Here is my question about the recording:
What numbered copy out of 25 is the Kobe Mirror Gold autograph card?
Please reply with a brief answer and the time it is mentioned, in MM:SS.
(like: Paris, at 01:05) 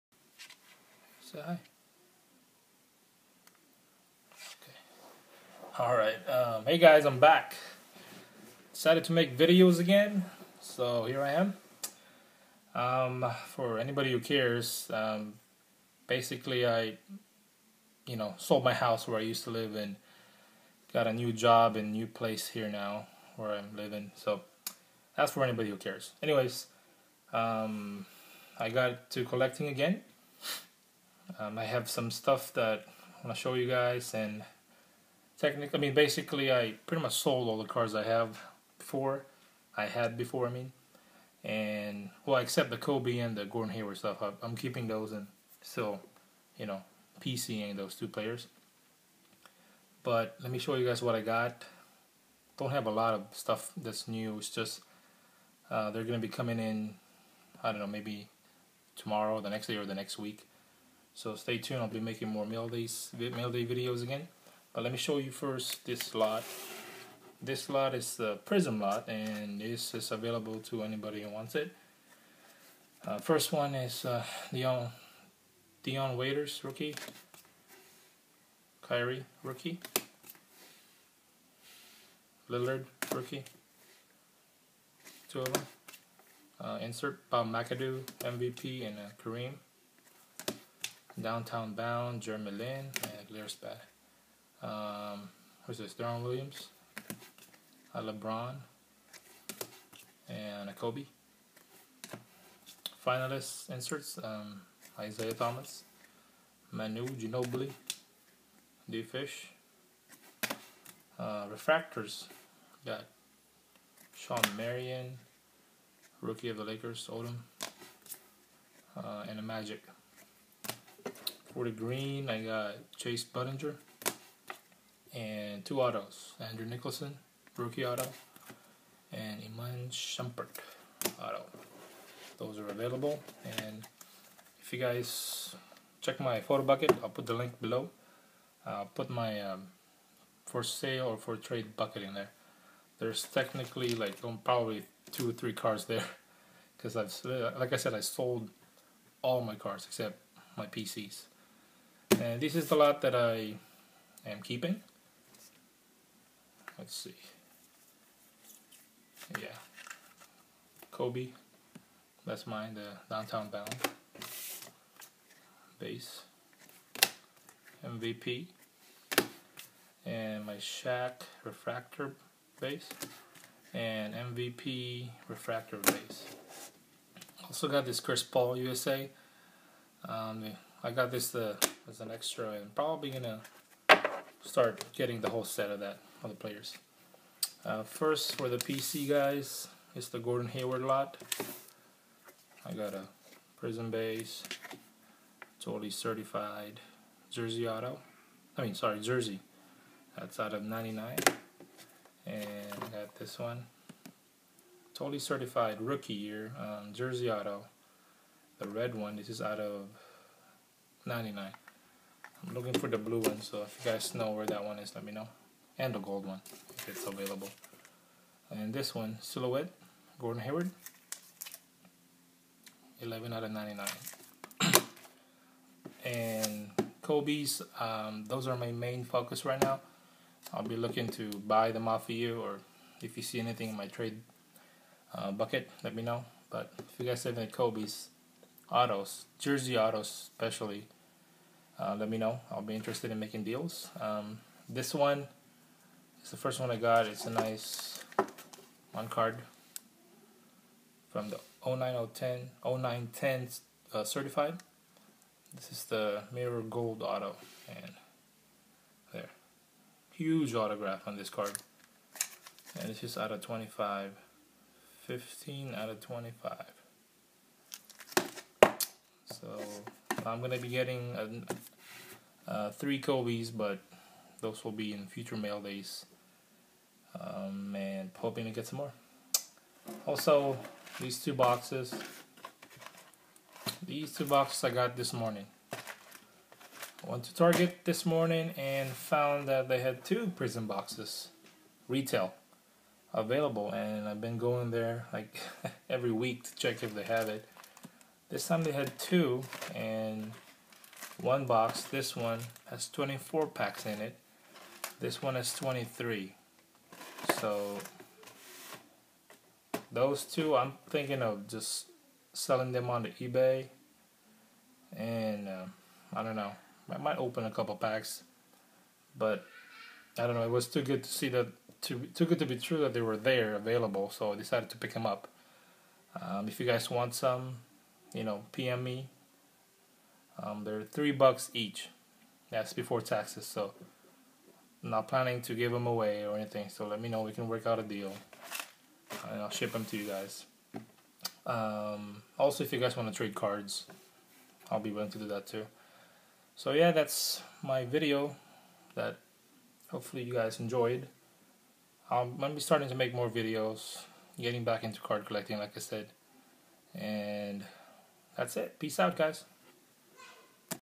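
15, at 04:25.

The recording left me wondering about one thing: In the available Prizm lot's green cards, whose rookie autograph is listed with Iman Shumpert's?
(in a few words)
Andrew Nicholson.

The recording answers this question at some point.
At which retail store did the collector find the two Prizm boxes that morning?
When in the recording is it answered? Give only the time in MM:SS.
04:47.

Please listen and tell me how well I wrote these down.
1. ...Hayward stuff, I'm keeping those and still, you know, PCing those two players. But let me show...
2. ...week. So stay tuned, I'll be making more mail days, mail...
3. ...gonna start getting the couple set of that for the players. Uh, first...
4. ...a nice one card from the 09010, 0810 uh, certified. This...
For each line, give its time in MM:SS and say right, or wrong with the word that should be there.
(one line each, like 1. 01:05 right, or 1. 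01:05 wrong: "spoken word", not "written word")
1. 00:43 right
2. 01:00 right
3. 03:03 wrong: "whole", not "couple"
4. 04:07 wrong: "0910", not "0810".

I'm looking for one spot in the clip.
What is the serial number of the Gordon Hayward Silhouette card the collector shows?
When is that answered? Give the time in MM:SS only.
03:42.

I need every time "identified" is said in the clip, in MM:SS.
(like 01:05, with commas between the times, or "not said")
not said.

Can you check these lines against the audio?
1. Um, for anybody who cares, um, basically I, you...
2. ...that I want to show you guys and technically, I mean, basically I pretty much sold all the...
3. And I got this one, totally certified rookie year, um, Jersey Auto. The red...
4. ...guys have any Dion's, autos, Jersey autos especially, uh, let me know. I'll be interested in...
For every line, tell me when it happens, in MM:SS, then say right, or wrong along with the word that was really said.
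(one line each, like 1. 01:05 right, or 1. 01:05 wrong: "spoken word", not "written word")
1. 00:12 right
2. 00:32 right
3. 03:22 right
4. 03:57 wrong: "Kobe", not "Dion".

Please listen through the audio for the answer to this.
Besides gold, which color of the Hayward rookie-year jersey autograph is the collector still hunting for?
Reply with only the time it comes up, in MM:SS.
03:32.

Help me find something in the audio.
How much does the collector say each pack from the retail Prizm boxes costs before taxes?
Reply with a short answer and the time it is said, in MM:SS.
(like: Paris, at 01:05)
$3, at 05:30.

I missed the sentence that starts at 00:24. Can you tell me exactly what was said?
So that's for anybody who cares.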